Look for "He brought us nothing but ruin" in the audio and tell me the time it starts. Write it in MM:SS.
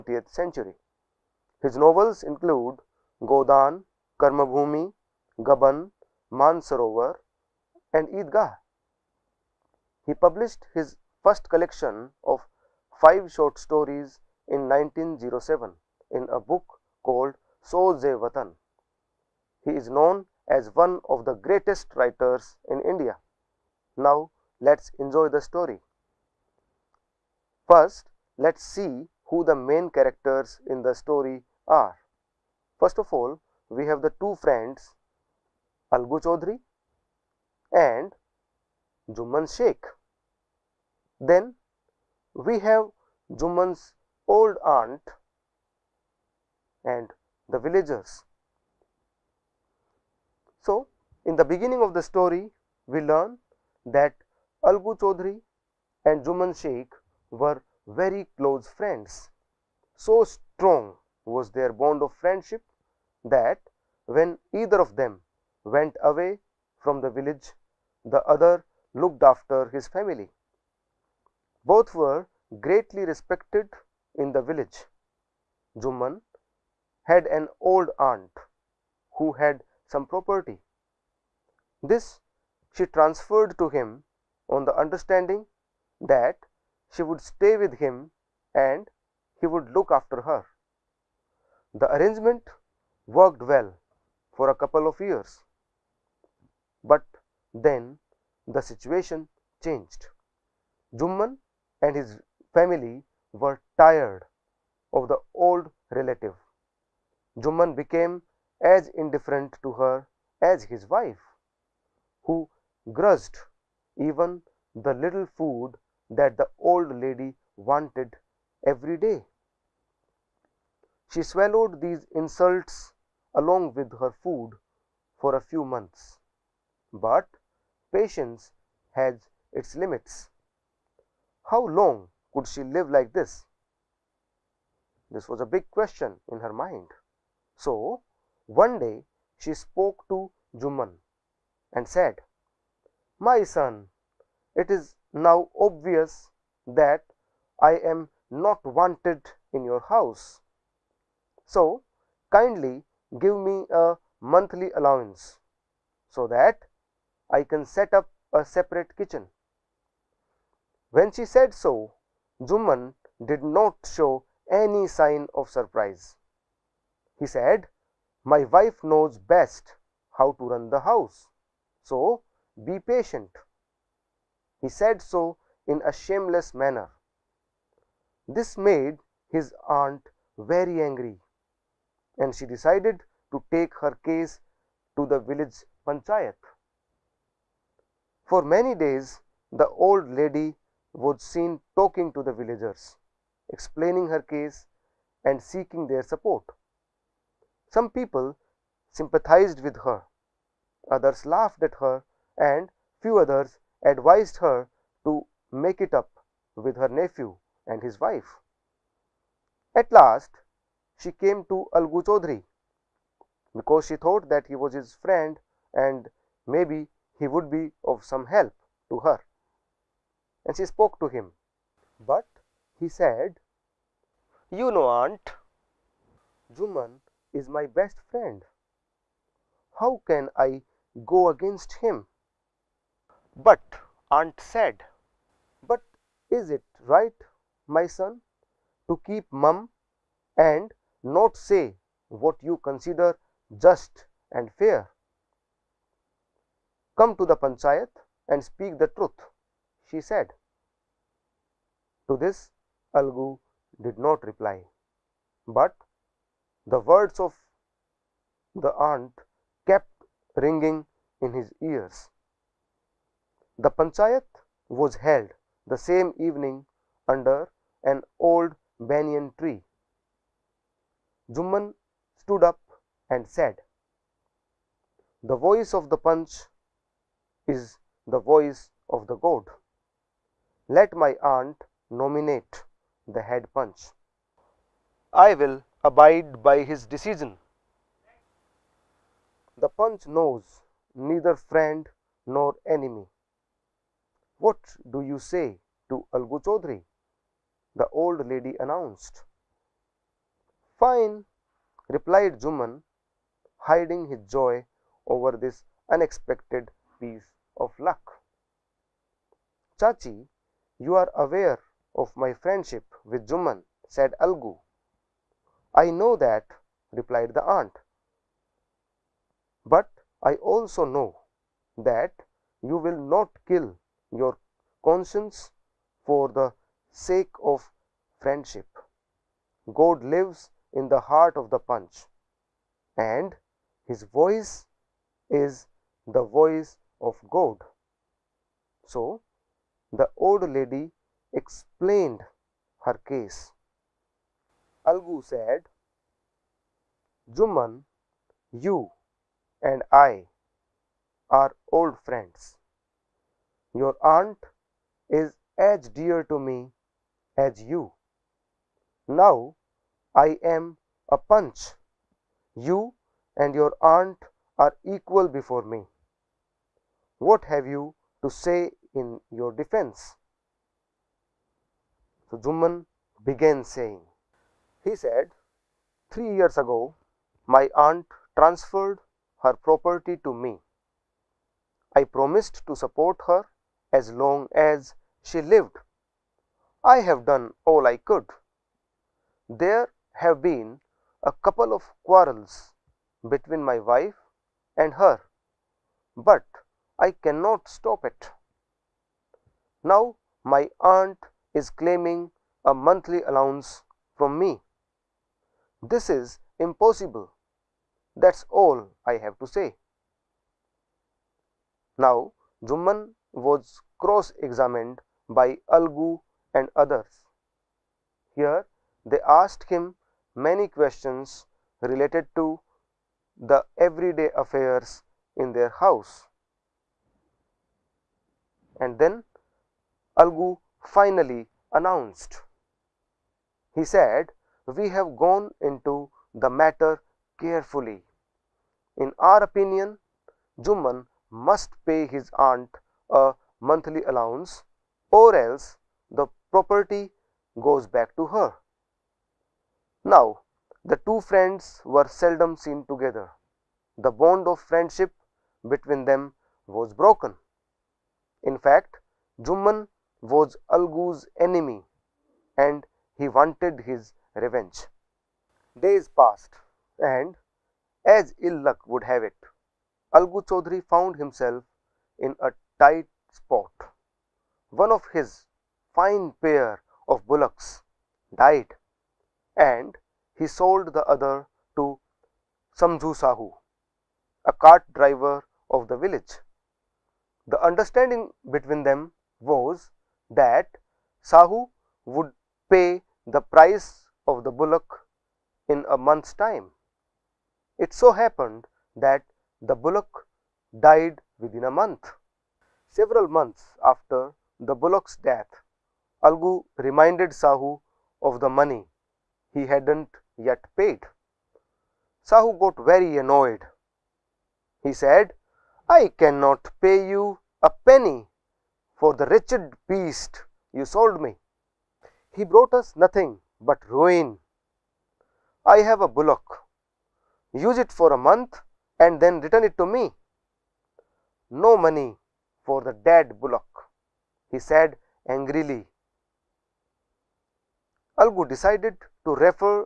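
08:42.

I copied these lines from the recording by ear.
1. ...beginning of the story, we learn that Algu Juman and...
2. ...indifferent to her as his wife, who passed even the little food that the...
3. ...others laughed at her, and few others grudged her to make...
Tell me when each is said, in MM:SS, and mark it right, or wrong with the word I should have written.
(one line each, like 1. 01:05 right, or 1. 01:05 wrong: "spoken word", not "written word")
1. 00:51 wrong: "Chaudhary", not "Juman"
2. 01:48 wrong: "grudged", not "passed"
3. 03:20 wrong: "advised", not "grudged".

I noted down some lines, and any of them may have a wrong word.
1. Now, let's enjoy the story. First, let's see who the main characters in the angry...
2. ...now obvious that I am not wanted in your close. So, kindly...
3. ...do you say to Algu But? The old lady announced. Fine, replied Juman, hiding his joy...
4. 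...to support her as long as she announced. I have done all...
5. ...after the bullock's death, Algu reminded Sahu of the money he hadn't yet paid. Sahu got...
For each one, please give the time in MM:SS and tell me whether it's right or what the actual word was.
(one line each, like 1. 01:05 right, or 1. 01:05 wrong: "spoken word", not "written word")
1. 00:23 wrong: "story", not "angry"
2. 02:25 wrong: "house", not "close"
3. 04:54 wrong: "Chaudhary", not "But"
4. 06:22 wrong: "lived", not "announced"
5. 08:23 right.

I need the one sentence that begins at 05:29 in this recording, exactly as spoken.
God lives in the heart of the Panch, and his voice is the voice of God.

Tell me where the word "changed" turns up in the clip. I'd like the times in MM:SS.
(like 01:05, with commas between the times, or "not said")
01:39.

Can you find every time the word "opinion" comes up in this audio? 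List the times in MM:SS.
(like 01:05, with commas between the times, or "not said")
07:19.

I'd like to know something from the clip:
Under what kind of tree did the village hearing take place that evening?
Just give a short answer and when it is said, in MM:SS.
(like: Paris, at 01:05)
an old banyan tree, at 04:28.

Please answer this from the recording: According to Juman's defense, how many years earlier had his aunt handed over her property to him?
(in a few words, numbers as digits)
3.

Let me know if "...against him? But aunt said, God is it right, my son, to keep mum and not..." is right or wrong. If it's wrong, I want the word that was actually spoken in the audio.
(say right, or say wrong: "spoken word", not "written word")
wrong: "But", not "God".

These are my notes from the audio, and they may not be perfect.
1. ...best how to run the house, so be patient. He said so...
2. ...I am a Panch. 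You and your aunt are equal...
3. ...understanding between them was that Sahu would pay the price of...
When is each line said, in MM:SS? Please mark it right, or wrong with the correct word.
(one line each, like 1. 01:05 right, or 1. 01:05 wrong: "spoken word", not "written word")
1. 02:49 right
2. 06:00 right
3. 08:07 right.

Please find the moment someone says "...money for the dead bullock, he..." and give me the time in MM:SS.
08:51.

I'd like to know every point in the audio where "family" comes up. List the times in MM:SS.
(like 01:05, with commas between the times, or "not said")
01:09, 01:42.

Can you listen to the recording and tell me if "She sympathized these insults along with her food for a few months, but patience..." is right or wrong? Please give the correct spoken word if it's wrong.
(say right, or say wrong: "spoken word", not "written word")
wrong: "swallowed", not "sympathized".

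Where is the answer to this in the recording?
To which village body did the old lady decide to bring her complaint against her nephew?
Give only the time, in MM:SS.
03:05.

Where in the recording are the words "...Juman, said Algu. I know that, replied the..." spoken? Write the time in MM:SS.
05:13.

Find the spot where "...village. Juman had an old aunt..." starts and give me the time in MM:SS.
01:14.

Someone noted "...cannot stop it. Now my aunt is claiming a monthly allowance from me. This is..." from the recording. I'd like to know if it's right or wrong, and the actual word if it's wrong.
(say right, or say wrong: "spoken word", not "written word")
right.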